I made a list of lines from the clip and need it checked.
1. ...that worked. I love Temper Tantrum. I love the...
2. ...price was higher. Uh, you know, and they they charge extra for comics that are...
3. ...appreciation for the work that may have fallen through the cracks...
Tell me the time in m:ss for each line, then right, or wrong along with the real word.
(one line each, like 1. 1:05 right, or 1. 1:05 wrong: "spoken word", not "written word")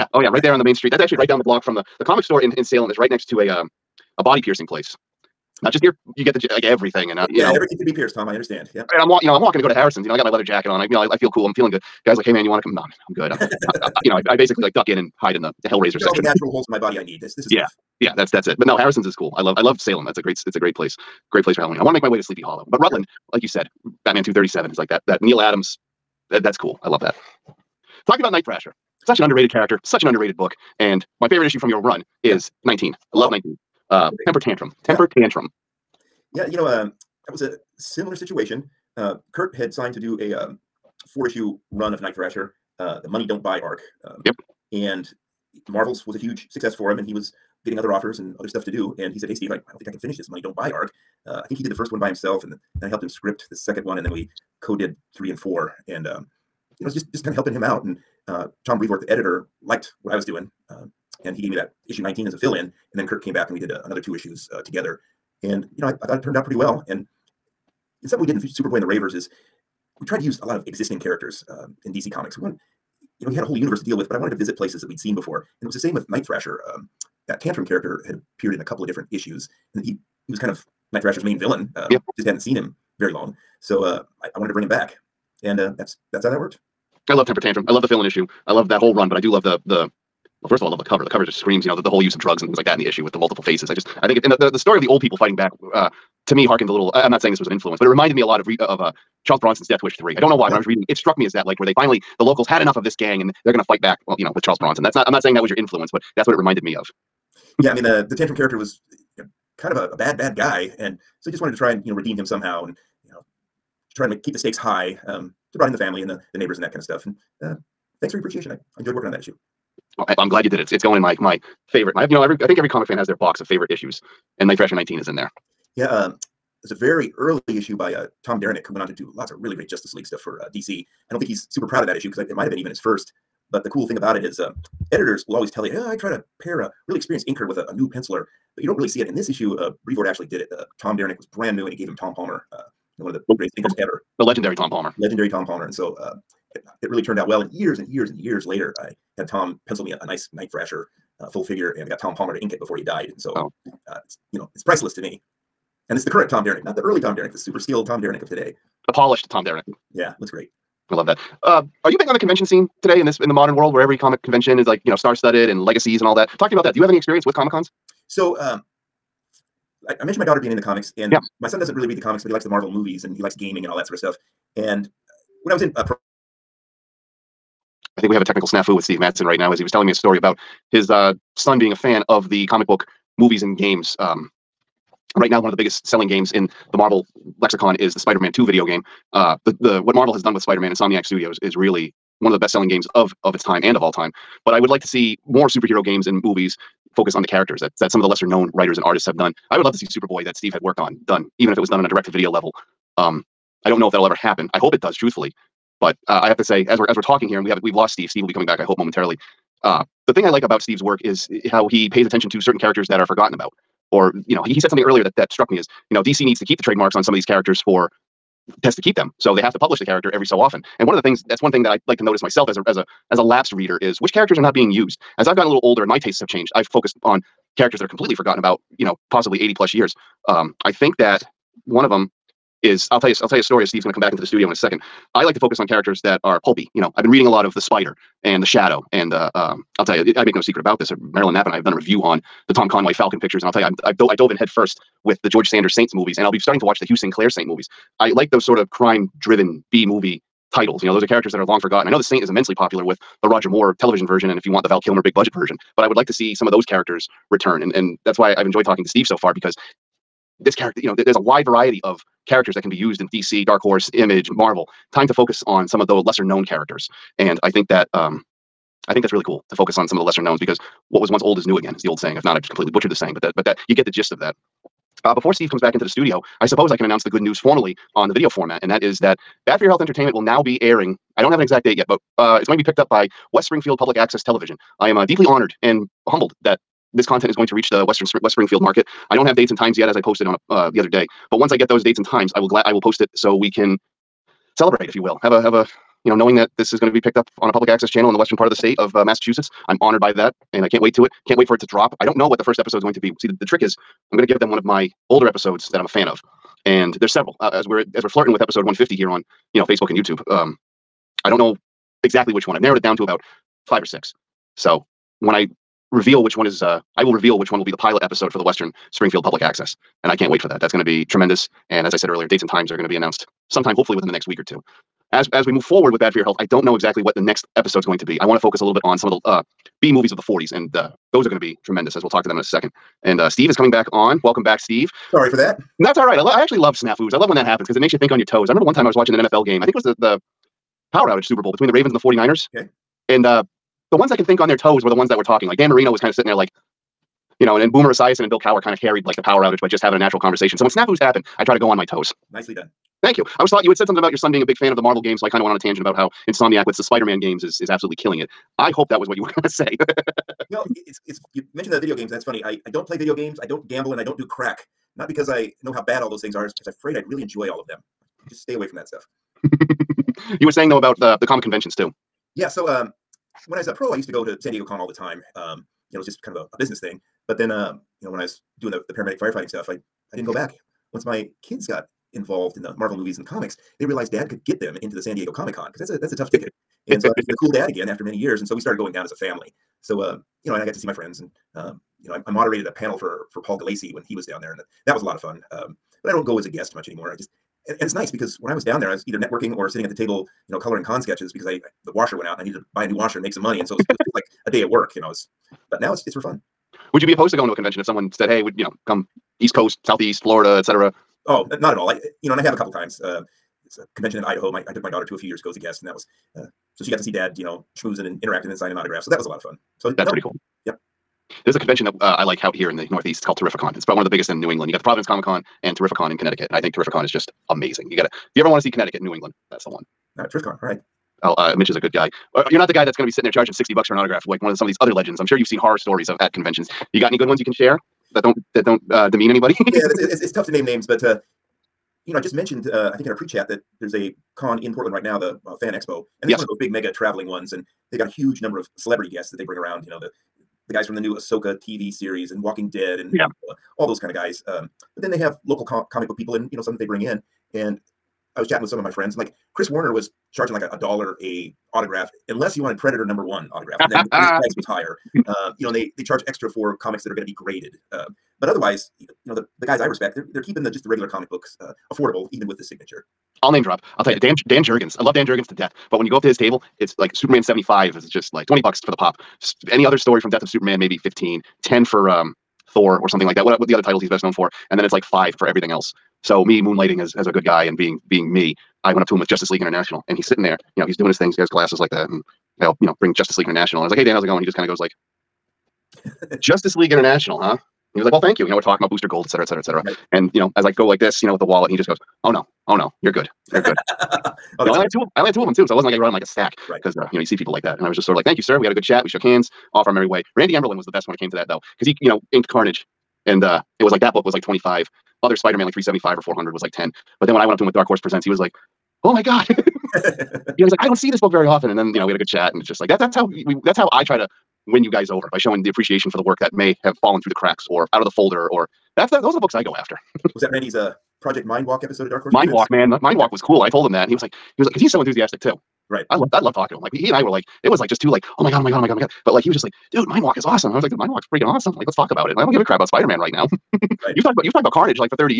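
1. 1:26 right
2. 7:44 right
3. 8:45 right.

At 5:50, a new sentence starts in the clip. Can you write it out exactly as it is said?
So when snafus happen, I try to go on my toes.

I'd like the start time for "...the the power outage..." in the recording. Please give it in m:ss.
5:39.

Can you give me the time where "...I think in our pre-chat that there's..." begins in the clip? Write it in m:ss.
7:22.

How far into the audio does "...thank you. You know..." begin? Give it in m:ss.
8:18.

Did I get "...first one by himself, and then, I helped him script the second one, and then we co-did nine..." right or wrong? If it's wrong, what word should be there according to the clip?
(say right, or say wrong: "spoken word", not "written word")
wrong: "three", not "nine".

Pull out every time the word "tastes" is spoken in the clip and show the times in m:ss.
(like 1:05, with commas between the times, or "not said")
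3:45.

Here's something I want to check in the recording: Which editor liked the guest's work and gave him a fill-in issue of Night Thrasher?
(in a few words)
Tom Brevoort.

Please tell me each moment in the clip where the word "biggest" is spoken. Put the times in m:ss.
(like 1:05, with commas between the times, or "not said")
3:05, 7:04.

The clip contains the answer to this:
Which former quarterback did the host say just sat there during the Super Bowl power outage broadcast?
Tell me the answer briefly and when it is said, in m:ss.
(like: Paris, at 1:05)
Dan Marino, at 5:45.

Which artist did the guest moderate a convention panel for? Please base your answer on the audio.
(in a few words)
Paul Gulacy.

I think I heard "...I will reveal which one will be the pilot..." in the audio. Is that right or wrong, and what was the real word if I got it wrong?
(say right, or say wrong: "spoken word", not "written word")
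right.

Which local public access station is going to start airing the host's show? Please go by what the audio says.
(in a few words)
West Springfield Public Access Television.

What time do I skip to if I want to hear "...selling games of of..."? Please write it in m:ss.
3:12.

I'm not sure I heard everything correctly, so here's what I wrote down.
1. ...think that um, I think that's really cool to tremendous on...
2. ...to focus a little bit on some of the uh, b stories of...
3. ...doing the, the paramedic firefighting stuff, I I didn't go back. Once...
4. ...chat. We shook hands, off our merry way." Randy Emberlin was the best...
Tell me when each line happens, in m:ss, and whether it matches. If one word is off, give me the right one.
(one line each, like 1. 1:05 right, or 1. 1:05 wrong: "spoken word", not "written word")
1. 4:27 wrong: "focus", not "tremendous"
2. 5:28 wrong: "movies", not "stories"
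3. 6:18 right
4. 8:28 right.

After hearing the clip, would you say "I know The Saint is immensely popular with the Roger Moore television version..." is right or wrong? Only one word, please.
right.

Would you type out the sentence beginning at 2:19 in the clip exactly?
In this issue, uh, Brevoort actually did it.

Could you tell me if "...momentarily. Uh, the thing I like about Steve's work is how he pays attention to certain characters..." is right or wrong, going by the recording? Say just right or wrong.
right.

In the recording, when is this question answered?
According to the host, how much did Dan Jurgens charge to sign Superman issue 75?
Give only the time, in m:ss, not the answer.
7:58.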